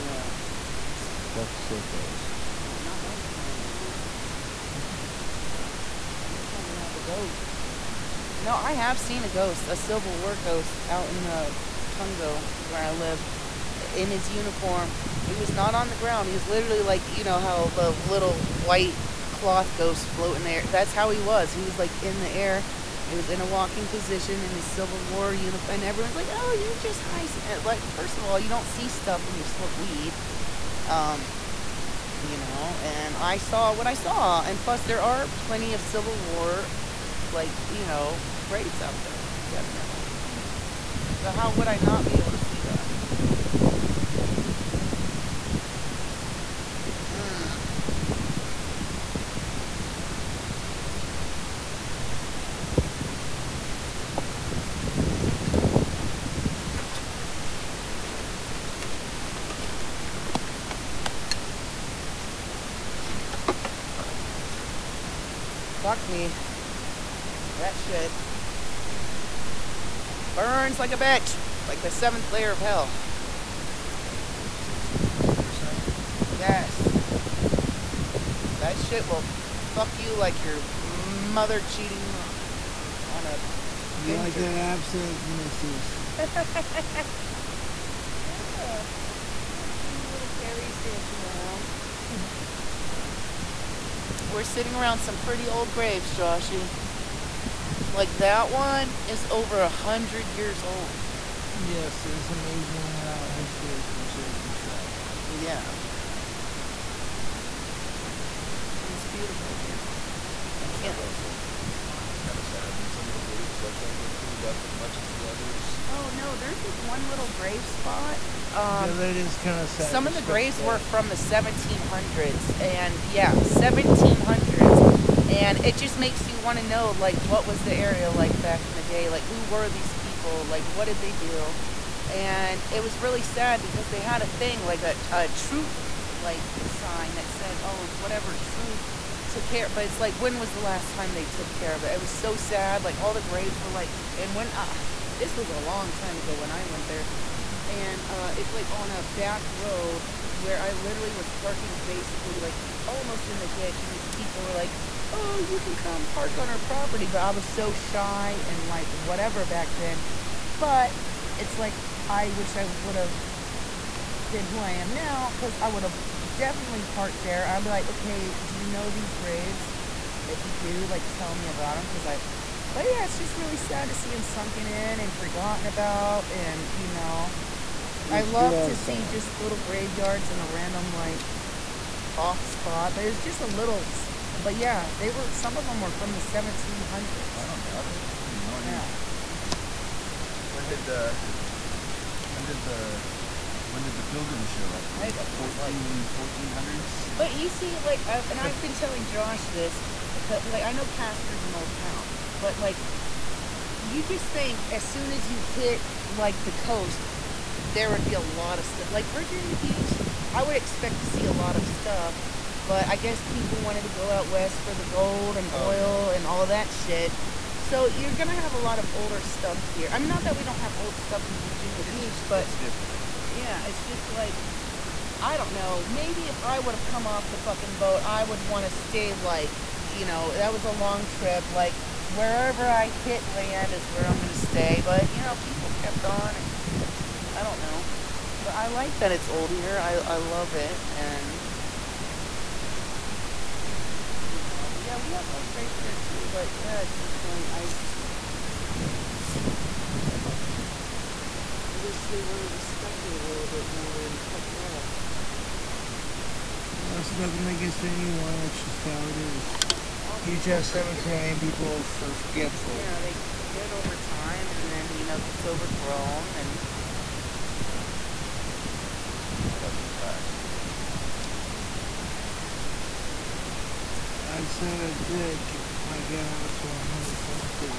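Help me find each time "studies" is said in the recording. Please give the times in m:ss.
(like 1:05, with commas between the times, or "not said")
not said.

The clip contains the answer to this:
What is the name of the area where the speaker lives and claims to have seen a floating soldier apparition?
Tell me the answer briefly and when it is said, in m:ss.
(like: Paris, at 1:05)
Pungo, at 0:11.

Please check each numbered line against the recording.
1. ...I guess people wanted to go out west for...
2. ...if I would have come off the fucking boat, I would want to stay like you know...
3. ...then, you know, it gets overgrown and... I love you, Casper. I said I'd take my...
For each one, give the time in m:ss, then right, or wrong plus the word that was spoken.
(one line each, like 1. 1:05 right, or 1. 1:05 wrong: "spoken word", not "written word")
1. 3:32 right
2. 3:46 right
3. 4:24 wrong: "Josh", not "Casper".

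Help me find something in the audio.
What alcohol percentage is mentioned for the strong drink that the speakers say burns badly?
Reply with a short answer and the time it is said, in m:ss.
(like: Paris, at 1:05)
62%, at 1:14.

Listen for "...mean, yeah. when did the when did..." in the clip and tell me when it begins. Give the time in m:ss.
3:08.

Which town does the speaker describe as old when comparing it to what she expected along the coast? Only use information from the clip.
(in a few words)
Casper.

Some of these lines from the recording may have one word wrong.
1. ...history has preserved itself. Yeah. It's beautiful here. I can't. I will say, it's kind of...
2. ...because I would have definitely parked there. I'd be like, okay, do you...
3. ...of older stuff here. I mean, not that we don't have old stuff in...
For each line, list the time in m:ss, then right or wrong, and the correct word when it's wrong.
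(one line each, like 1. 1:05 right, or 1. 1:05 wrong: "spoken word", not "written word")
1. 1:43 right
2. 2:45 right
3. 3:38 right.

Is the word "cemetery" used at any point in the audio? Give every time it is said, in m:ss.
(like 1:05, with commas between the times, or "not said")
4:20, 4:37.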